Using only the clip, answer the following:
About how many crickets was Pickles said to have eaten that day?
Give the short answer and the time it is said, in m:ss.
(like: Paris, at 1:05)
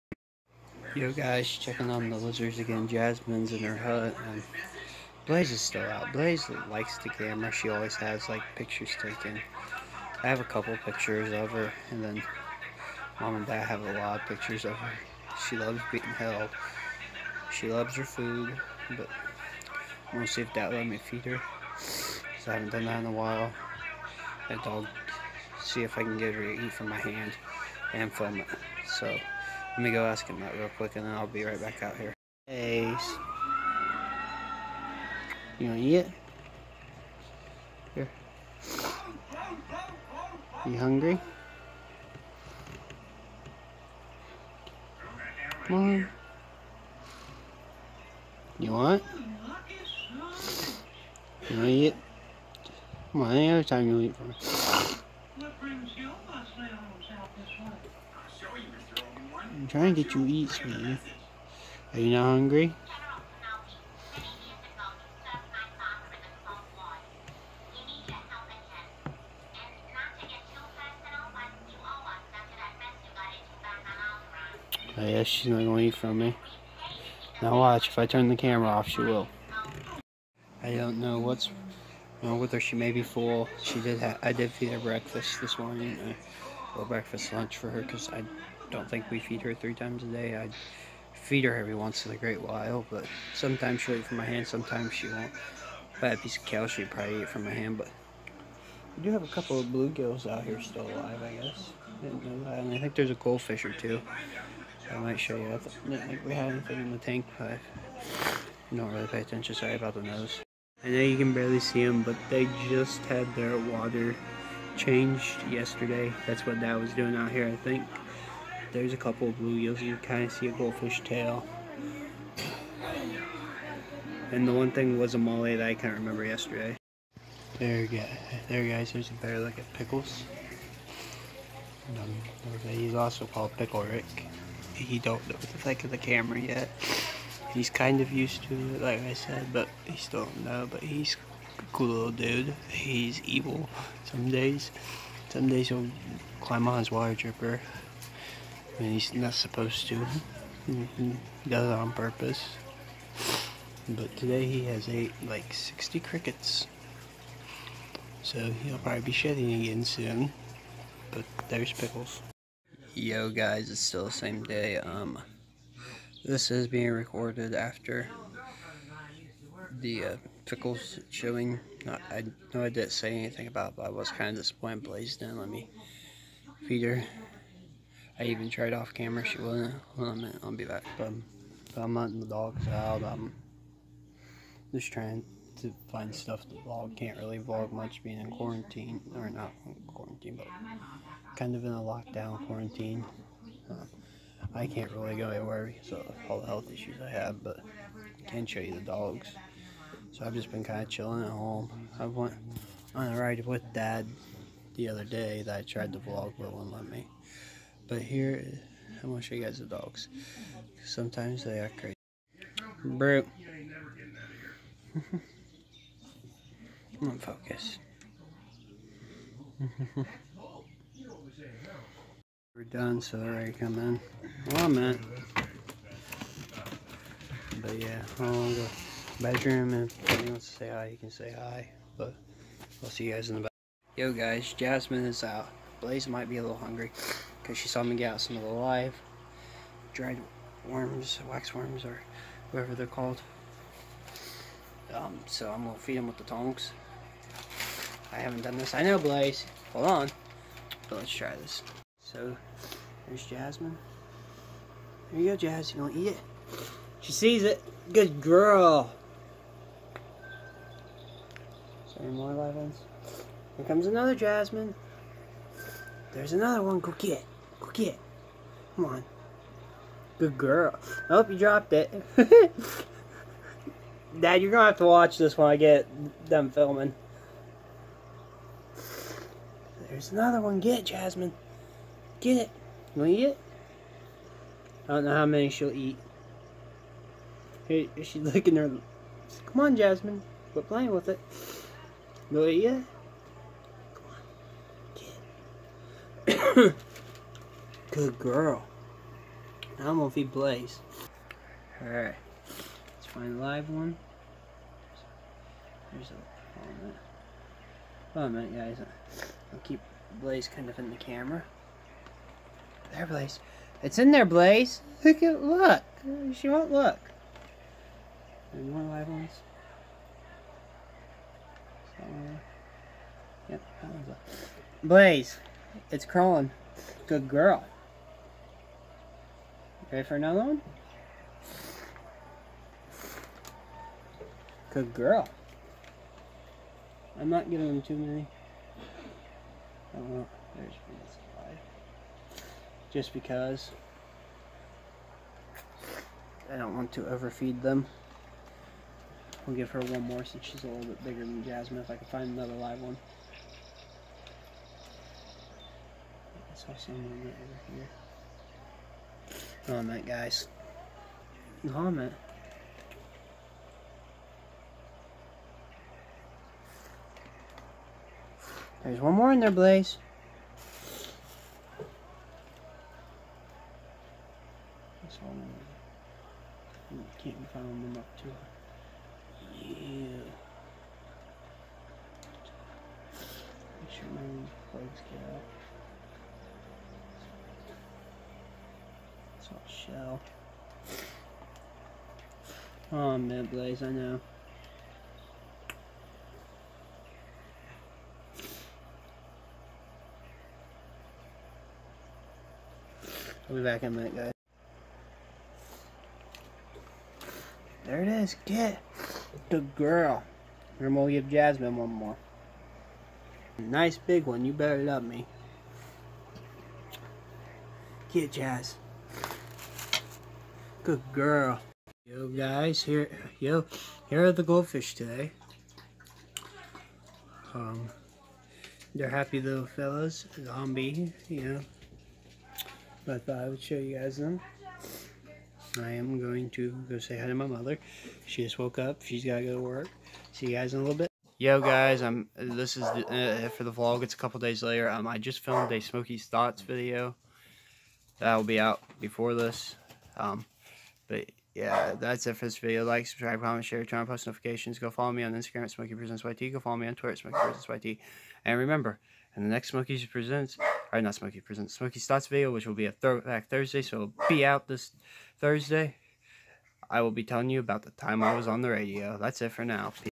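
60, at 2:35.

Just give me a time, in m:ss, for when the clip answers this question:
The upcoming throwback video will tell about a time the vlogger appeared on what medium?
7:48.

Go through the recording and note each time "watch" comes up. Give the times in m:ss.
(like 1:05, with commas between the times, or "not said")
1:17, 4:34.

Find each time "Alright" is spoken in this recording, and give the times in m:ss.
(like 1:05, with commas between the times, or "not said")
5:00.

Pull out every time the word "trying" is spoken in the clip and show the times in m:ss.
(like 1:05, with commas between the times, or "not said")
0:59, 3:04.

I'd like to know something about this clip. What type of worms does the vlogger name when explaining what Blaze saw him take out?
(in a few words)
Wax worms.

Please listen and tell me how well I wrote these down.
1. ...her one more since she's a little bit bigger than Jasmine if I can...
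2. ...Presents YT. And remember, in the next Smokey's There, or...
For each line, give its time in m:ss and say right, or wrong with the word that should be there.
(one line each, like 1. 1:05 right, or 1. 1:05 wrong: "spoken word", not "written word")
1. 5:49 right
2. 7:37 wrong: "Presents", not "There".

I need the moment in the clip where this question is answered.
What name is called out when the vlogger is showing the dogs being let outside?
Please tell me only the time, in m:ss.
3:32.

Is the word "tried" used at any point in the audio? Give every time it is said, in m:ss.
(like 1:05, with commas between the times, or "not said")
2:58, 3:25.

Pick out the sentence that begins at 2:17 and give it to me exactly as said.
He's kind of used to it, like I said, but he still don't know.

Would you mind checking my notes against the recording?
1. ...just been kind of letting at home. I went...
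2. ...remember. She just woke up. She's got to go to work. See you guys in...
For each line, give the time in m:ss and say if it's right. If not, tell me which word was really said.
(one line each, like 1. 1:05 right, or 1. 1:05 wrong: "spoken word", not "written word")
1. 3:20 wrong: "chilling", not "letting"
2. 7:17 wrong: "mother", not "remember".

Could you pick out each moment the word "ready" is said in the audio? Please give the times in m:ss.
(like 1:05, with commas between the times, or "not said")
3:43, 5:29.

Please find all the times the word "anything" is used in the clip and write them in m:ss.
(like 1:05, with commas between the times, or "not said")
1:46, 2:53.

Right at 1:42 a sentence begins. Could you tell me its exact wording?
And I think there's a goldfish or two.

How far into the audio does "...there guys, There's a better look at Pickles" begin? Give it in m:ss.
2:08.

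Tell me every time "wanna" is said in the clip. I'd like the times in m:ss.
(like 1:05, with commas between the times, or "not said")
0:35, 0:51.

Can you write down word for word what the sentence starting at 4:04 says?
Um, so I'm gonna feed them with the tongs.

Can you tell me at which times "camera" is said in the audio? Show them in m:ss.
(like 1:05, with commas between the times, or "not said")
0:07, 1:18, 2:15, 2:58, 5:10.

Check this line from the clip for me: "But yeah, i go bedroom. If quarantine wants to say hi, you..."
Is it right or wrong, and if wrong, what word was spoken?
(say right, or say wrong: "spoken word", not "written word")
wrong: "anyone", not "quarantine".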